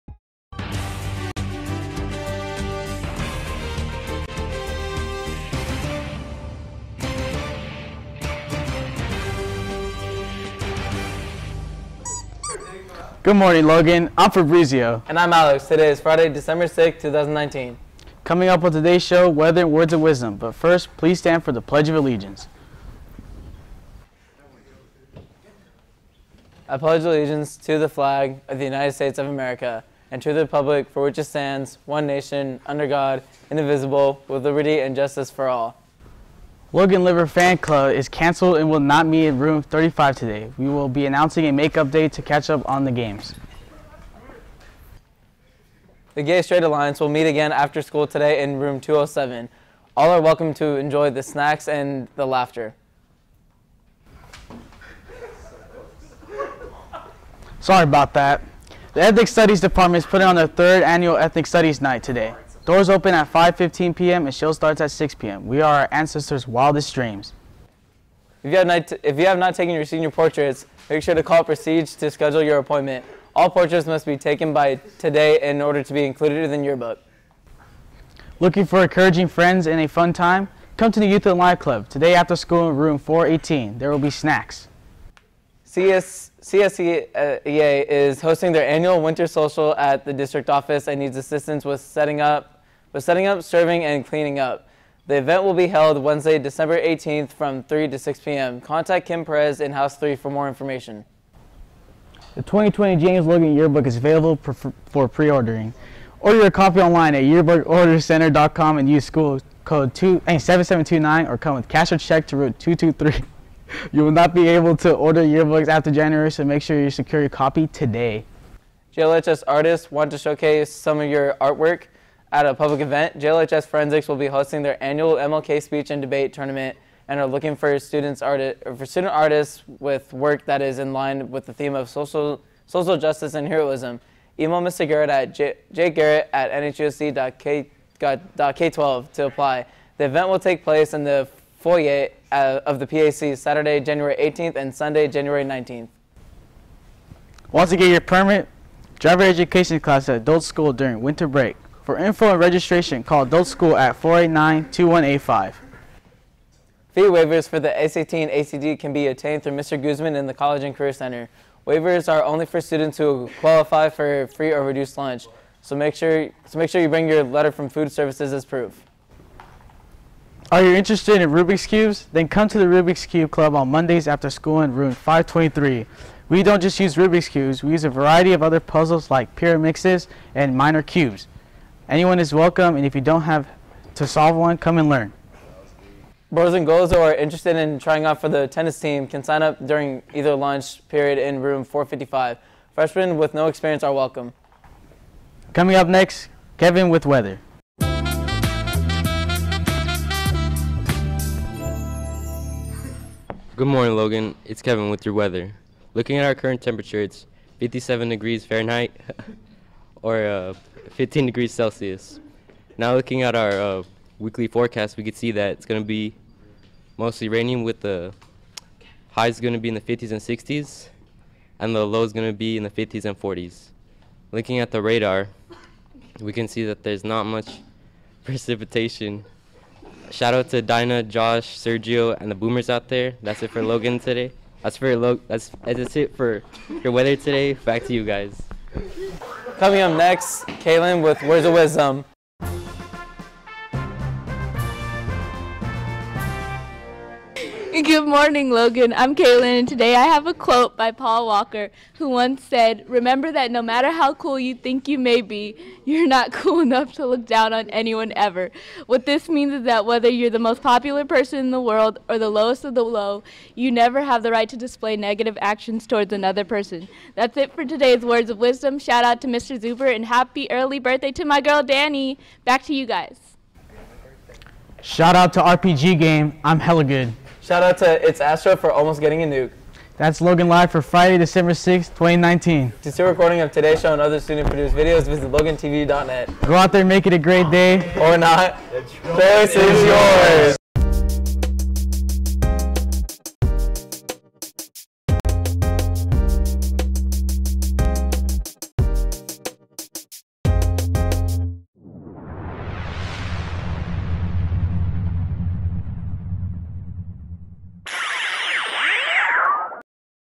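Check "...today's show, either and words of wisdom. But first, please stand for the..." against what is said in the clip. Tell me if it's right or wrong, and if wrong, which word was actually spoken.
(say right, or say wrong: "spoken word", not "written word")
wrong: "weather", not "either".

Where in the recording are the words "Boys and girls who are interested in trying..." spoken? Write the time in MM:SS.
03:06.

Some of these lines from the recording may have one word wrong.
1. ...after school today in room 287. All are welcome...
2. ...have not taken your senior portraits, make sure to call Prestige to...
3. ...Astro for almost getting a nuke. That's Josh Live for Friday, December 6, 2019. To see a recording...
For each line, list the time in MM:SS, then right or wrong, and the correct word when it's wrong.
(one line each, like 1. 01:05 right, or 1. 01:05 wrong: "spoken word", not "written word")
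1. 00:47 wrong: "207", not "287"
2. 01:09 right
3. 04:38 wrong: "Logan", not "Josh".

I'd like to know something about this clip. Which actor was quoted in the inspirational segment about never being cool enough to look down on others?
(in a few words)
Paul Walker.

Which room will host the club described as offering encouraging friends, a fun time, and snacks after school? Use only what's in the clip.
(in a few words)
Room 418.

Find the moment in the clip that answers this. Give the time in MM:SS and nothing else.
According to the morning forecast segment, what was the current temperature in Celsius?
03:30.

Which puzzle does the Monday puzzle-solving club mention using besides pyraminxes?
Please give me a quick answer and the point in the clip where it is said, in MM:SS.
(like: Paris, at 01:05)
Mirror cubes, at 03:00.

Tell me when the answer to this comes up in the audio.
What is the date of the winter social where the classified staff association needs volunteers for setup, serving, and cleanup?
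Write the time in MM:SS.
01:36.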